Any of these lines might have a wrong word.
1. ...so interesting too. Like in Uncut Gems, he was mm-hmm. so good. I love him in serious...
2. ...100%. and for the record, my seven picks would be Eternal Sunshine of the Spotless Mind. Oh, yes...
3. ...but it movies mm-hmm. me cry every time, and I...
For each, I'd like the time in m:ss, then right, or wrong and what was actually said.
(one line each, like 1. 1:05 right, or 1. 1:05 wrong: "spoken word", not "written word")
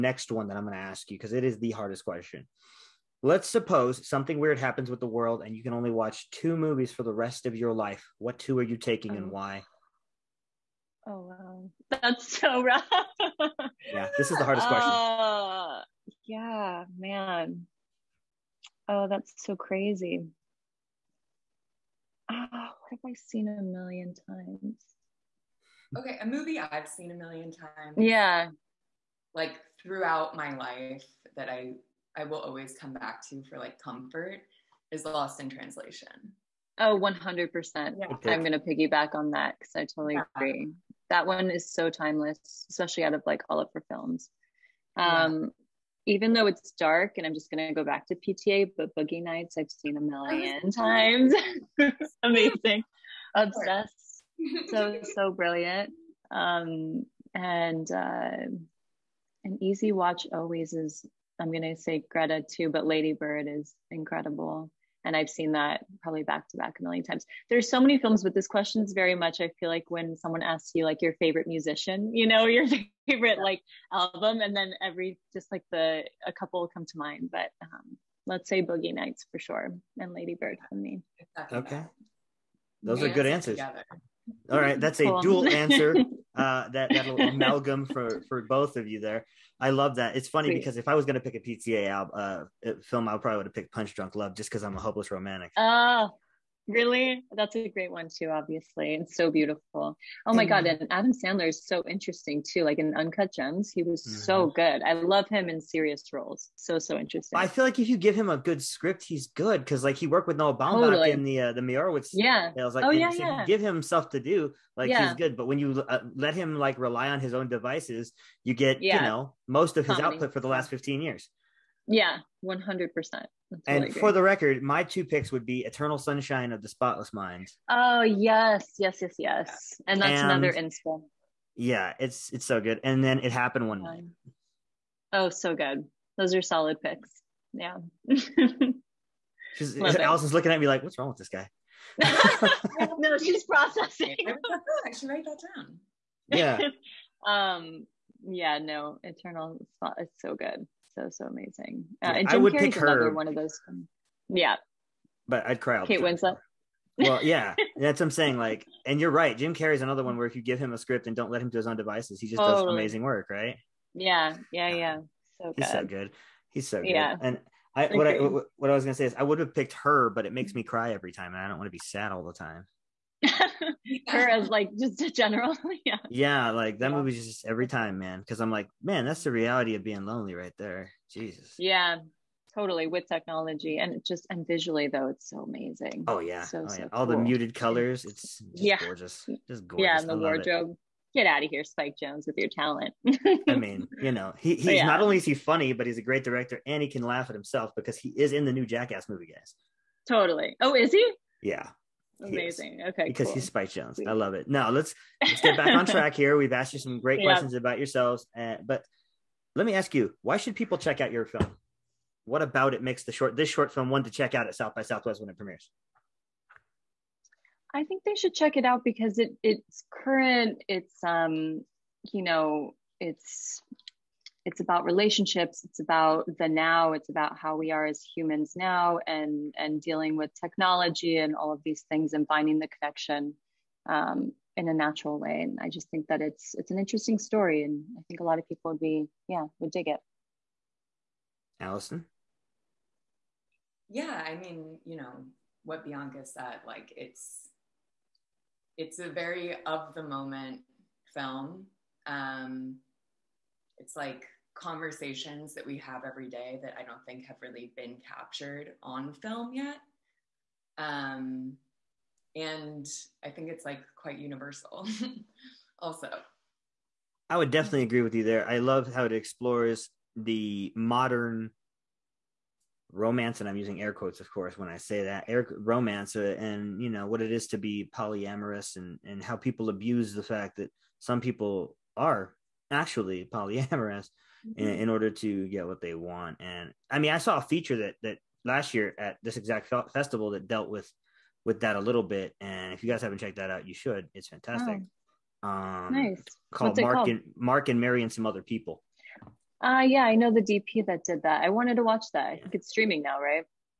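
1. 1:41 right
2. 2:02 wrong: "two", not "seven"
3. 2:50 wrong: "makes", not "movies".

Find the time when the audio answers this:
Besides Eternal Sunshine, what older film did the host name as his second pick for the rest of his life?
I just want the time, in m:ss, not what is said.
2:13.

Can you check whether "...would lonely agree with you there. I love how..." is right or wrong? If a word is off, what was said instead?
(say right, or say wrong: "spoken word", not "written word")
wrong: "definitely", not "lonely".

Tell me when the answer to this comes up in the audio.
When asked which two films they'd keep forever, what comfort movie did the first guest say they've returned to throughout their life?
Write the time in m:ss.
0:35.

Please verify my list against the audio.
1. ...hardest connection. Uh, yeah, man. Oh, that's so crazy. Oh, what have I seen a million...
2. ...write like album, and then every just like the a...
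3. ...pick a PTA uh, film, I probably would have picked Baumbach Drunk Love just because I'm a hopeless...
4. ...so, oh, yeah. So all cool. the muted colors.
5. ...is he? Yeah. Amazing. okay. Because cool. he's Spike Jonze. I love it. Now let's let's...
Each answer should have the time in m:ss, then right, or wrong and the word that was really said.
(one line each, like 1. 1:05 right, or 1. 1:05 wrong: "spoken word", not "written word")
1. 0:14 wrong: "question", not "connection"
2. 1:13 wrong: "favorite", not "write"
3. 1:31 wrong: "Punch", not "Baumbach"
4. 3:06 right
5. 3:20 right.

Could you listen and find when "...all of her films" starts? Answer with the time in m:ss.
0:43.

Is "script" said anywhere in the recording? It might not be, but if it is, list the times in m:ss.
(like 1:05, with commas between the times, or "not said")
1:48, 2:40.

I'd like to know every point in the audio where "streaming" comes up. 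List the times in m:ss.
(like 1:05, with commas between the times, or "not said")
5:02.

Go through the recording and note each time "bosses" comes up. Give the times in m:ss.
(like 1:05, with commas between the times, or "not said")
not said.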